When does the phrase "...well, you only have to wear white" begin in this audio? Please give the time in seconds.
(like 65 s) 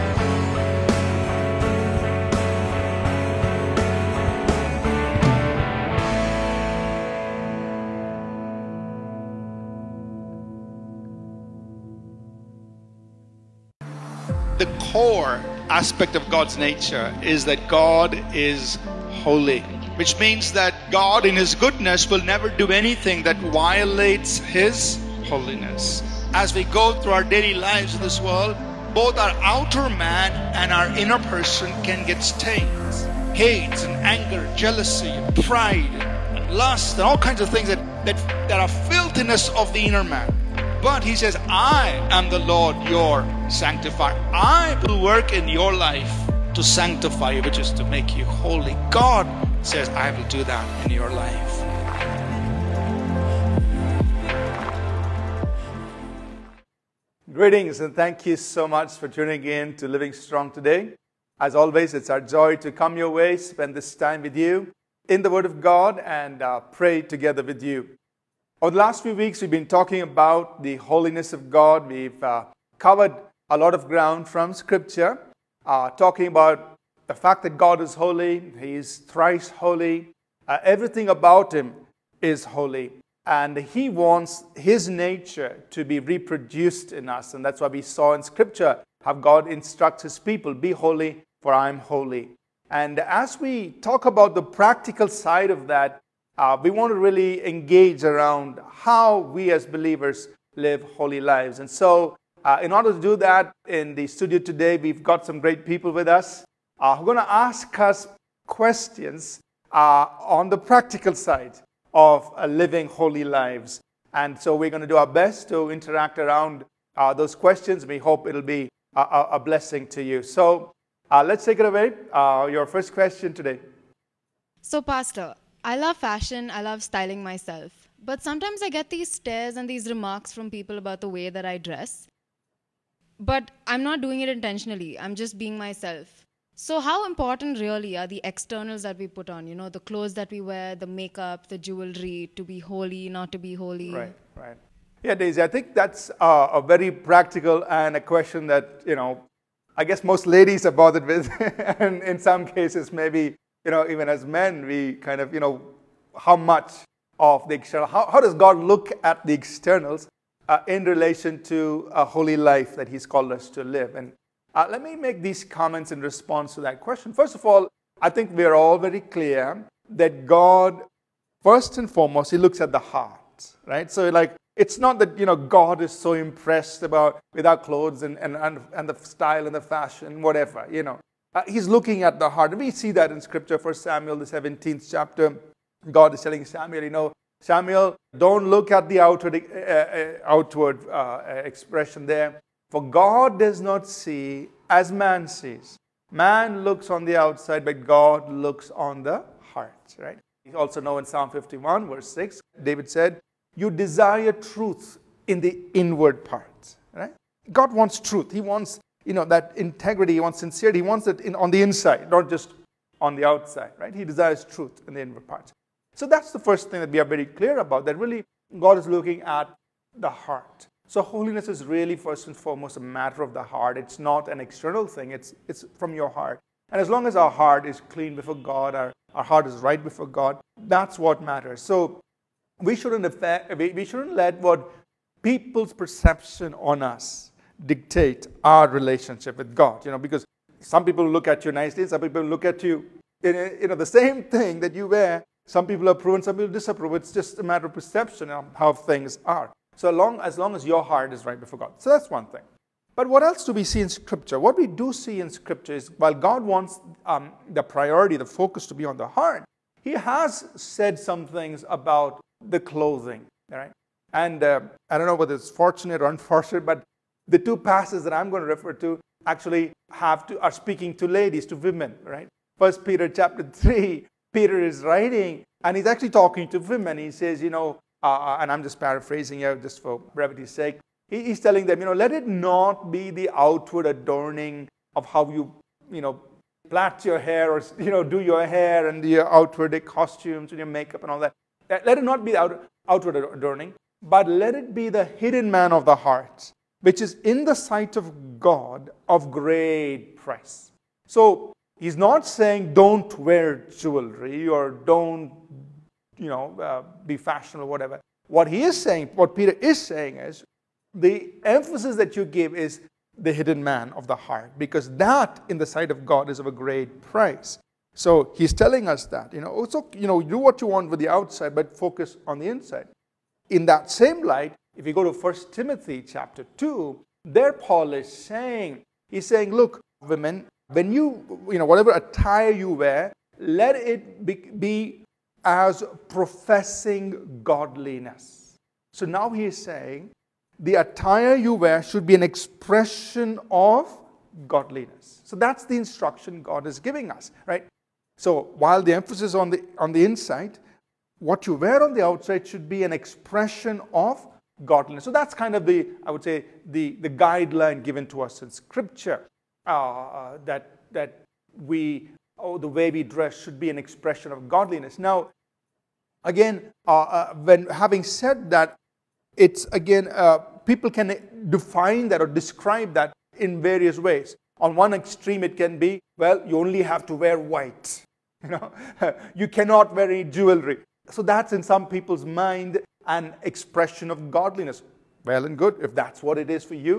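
376 s.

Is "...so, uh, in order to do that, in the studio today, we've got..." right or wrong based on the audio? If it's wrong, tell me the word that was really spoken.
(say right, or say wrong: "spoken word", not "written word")
right.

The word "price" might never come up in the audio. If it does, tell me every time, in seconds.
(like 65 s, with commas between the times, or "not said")
300 s, 316 s.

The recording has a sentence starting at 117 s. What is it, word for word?
We hope it'll be a, a, a blessing to you.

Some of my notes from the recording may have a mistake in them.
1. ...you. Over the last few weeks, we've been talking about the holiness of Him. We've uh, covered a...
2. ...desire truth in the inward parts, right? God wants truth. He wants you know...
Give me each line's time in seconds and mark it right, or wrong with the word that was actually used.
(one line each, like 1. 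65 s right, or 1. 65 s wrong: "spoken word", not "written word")
1. 67 s wrong: "God", not "Him"
2. 203 s right.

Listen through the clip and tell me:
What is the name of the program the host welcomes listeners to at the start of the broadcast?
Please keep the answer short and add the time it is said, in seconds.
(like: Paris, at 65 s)
Living Strong, at 59 s.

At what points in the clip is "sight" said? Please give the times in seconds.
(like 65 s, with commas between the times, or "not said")
297 s, 315 s.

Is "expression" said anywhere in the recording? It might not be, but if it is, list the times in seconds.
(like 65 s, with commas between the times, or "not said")
191 s, 342 s, 352 s, 363 s, 383 s.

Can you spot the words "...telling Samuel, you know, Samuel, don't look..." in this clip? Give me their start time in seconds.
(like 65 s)
186 s.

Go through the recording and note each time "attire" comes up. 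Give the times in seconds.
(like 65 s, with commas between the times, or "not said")
331 s, 340 s.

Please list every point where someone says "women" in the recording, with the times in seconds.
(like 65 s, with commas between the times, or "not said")
271 s, 276 s, 330 s.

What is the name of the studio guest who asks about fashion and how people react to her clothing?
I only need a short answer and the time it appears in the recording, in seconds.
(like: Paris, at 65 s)
Daisy, at 145 s.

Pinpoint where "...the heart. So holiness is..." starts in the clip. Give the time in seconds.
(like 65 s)
219 s.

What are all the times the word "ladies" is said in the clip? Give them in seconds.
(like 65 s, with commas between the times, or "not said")
150 s, 271 s.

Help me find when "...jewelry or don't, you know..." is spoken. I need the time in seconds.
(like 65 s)
303 s.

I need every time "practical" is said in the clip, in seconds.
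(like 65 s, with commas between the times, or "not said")
94 s, 110 s, 146 s.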